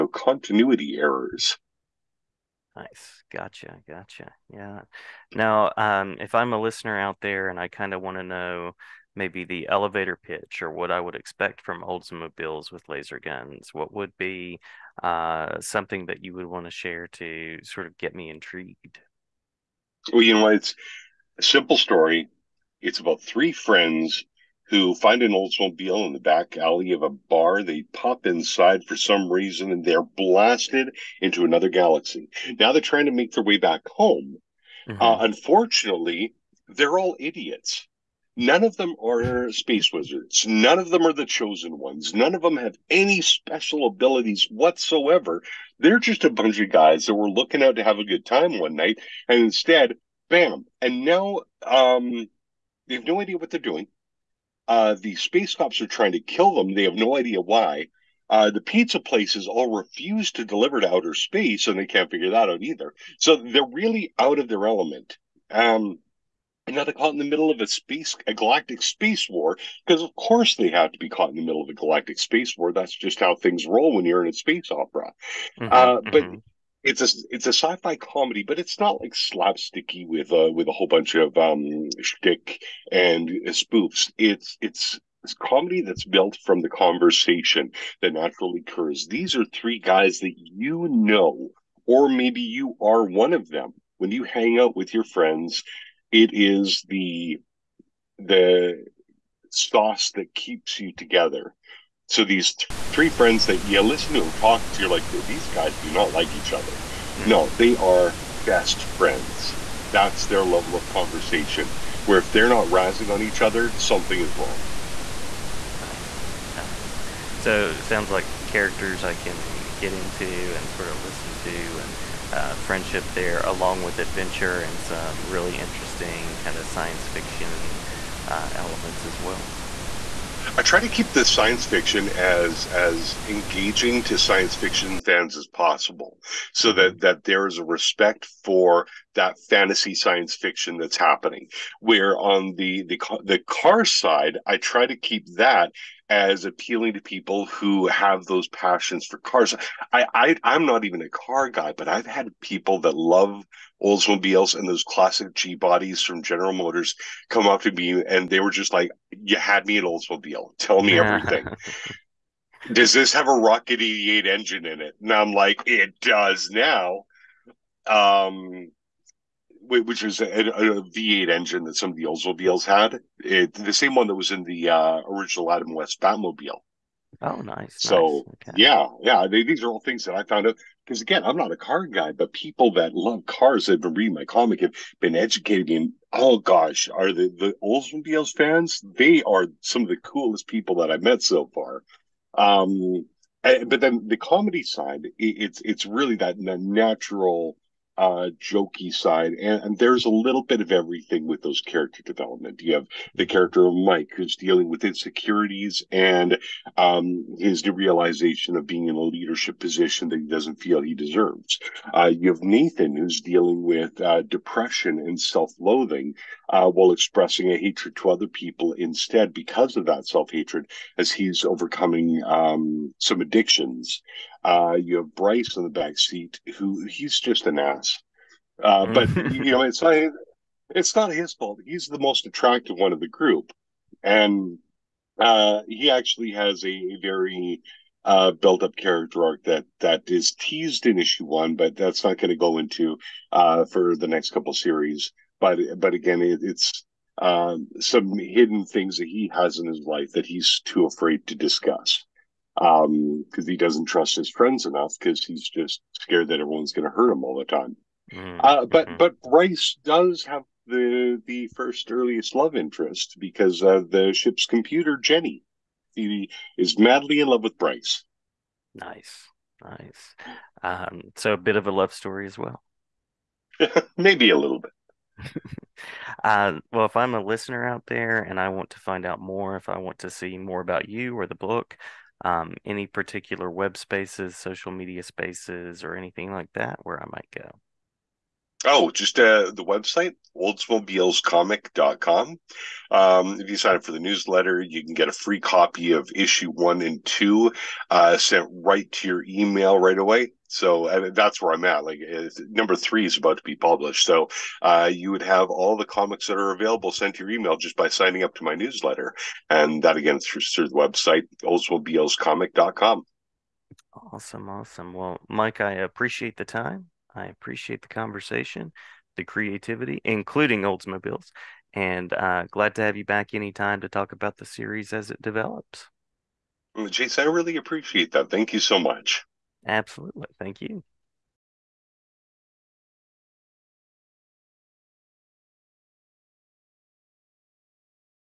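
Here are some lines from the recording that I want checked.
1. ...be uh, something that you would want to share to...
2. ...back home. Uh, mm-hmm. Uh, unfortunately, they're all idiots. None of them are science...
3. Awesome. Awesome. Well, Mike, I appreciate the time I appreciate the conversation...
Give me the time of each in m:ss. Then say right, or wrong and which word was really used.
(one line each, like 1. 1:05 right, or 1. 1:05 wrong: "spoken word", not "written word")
1. 0:14 right
2. 0:33 wrong: "space", not "science"
3. 5:14 right.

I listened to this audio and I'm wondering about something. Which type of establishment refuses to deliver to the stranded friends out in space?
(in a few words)
Pizza places.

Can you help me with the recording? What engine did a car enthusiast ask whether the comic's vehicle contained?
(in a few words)
Rocket 88.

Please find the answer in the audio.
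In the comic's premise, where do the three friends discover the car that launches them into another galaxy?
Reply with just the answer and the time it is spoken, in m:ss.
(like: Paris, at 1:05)
Back alley of a bar, at 0:26.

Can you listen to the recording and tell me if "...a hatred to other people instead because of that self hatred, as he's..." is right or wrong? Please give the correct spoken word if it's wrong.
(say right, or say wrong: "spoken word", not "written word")
right.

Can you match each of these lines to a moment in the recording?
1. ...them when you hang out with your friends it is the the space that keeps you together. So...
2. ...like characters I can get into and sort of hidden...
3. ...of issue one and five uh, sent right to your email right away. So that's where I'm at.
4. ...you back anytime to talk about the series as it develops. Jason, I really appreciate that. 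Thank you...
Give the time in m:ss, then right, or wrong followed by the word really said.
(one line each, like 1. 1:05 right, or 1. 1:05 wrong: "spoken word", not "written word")
1. 1:33 wrong: "sauce", not "space"
2. 1:58 wrong: "listen", not "hidden"
3. 4:55 wrong: "two", not "five"
4. 5:22 right.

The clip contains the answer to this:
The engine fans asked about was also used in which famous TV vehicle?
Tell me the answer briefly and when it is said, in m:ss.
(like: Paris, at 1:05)
Adam West Batmobile, at 2:55.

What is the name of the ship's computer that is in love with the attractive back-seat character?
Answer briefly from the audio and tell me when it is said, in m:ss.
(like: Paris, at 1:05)
Jenny, at 4:24.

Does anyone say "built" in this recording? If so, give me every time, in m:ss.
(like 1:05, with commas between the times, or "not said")
1:26, 3:58.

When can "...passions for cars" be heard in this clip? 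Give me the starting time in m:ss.
2:28.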